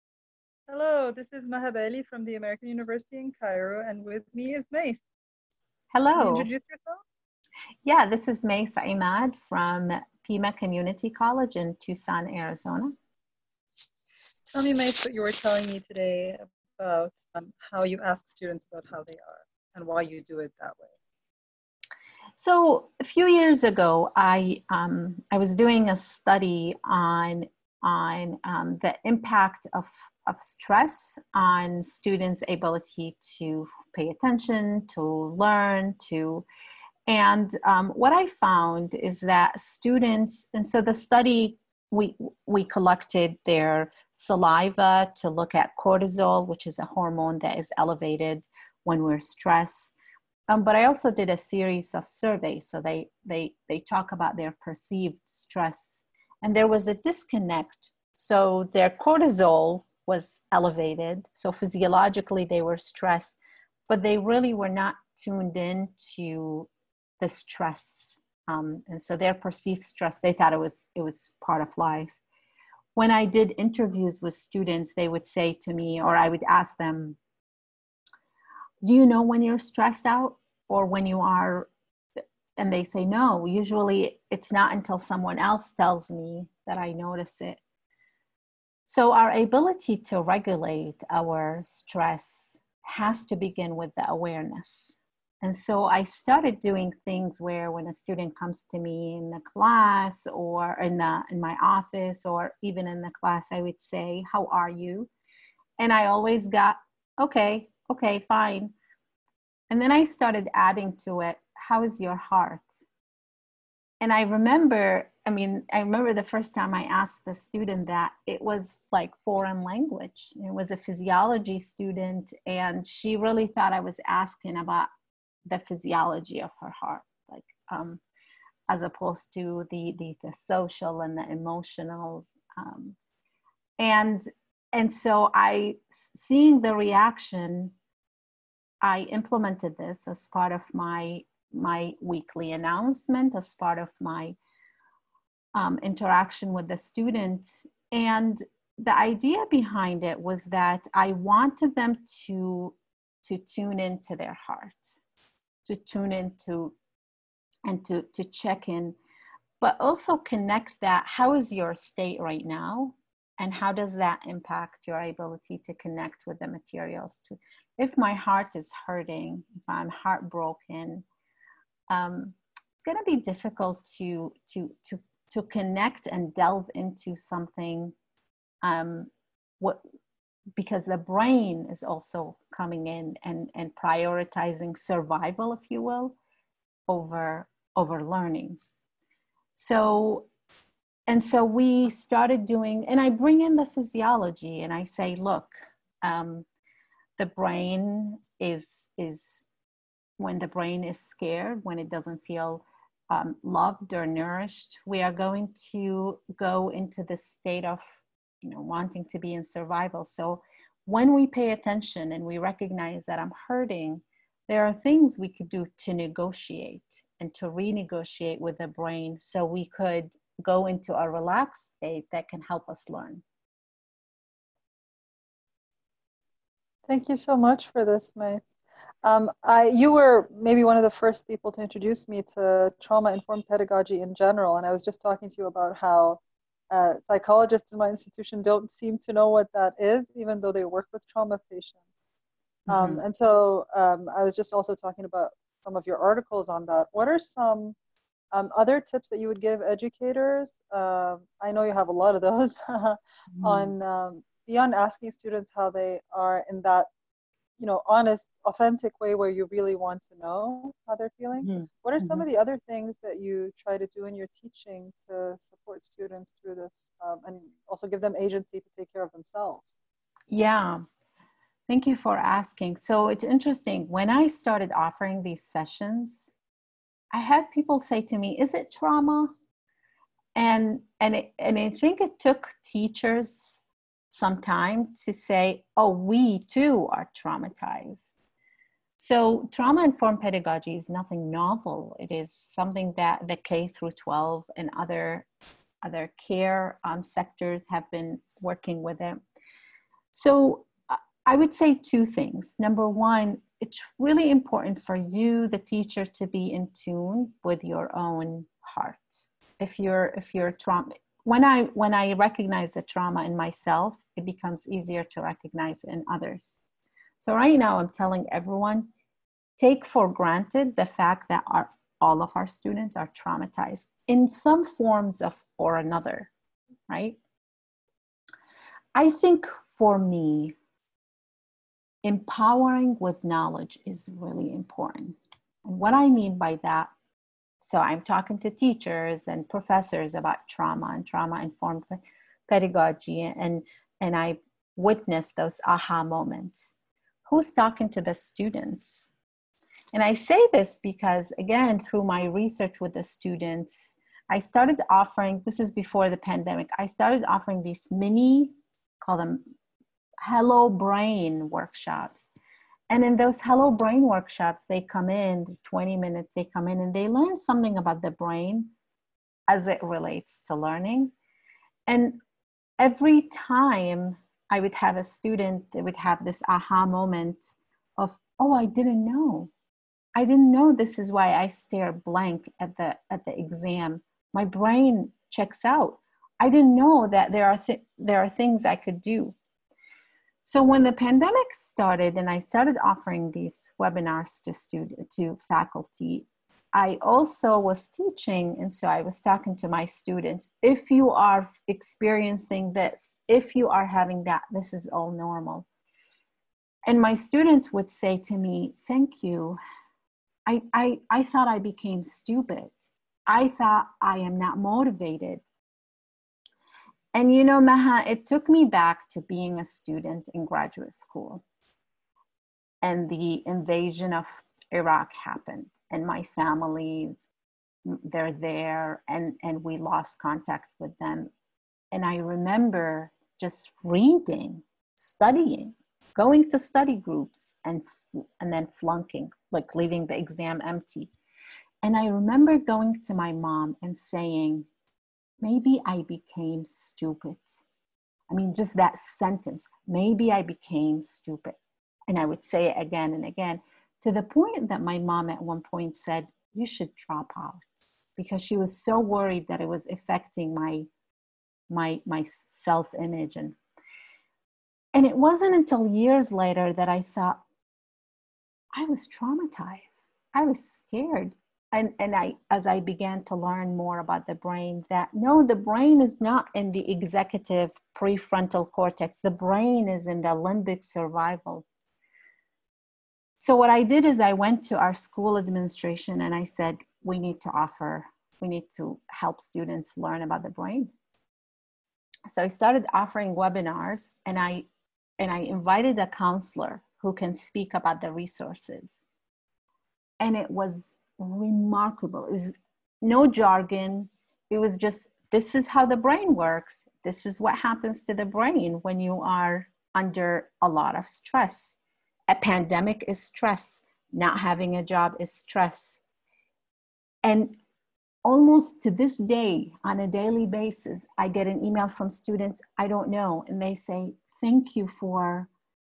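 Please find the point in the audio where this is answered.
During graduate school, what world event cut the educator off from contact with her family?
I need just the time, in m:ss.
7:03.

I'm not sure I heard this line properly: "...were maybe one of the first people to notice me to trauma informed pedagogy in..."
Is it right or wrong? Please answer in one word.
wrong.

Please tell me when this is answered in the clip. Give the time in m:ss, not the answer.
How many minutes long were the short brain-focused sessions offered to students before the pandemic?
6:05.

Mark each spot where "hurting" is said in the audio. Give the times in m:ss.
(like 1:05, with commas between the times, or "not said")
2:48, 3:33.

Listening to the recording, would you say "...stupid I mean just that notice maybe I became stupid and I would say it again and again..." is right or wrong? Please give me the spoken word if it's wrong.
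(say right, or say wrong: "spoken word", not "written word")
wrong: "sentence", not "notice".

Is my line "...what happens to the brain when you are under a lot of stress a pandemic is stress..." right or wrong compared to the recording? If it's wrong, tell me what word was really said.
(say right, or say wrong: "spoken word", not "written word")
right.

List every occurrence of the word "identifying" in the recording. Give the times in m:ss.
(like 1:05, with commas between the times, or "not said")
not said.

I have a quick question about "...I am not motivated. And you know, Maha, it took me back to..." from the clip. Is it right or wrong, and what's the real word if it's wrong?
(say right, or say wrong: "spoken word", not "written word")
right.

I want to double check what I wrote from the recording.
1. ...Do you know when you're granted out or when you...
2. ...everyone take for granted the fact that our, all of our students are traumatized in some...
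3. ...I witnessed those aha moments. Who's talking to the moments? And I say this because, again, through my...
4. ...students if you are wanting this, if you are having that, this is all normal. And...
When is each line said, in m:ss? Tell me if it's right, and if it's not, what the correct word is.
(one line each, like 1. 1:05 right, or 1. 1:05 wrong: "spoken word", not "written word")
1. 1:18 wrong: "stressed", not "granted"
2. 5:18 right
3. 5:44 wrong: "students", not "moments"
4. 6:39 wrong: "experiencing", not "wanting".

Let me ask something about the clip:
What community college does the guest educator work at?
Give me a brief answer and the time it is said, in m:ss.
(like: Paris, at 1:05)
Pima Community College, at 0:10.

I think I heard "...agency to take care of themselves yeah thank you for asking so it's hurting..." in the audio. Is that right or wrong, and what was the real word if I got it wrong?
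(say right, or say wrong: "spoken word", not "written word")
wrong: "interesting", not "hurting".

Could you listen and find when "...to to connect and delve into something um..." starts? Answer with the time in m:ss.
2:54.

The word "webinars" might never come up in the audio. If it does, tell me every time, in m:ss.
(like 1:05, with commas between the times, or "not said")
6:33, 8:13.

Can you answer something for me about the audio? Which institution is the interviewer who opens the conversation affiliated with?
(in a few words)
American University in Cairo.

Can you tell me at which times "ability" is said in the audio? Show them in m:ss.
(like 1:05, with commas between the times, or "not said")
0:32, 1:29, 2:45.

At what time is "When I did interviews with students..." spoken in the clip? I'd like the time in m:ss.
1:12.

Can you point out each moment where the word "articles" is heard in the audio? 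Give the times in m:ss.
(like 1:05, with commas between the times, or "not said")
4:05.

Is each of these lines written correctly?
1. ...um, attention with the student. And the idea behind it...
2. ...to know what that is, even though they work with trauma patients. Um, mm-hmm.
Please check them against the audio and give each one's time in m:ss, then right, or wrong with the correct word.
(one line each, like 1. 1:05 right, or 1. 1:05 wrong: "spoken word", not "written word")
1. 2:25 wrong: "interaction", not "attention"
2. 3:58 right.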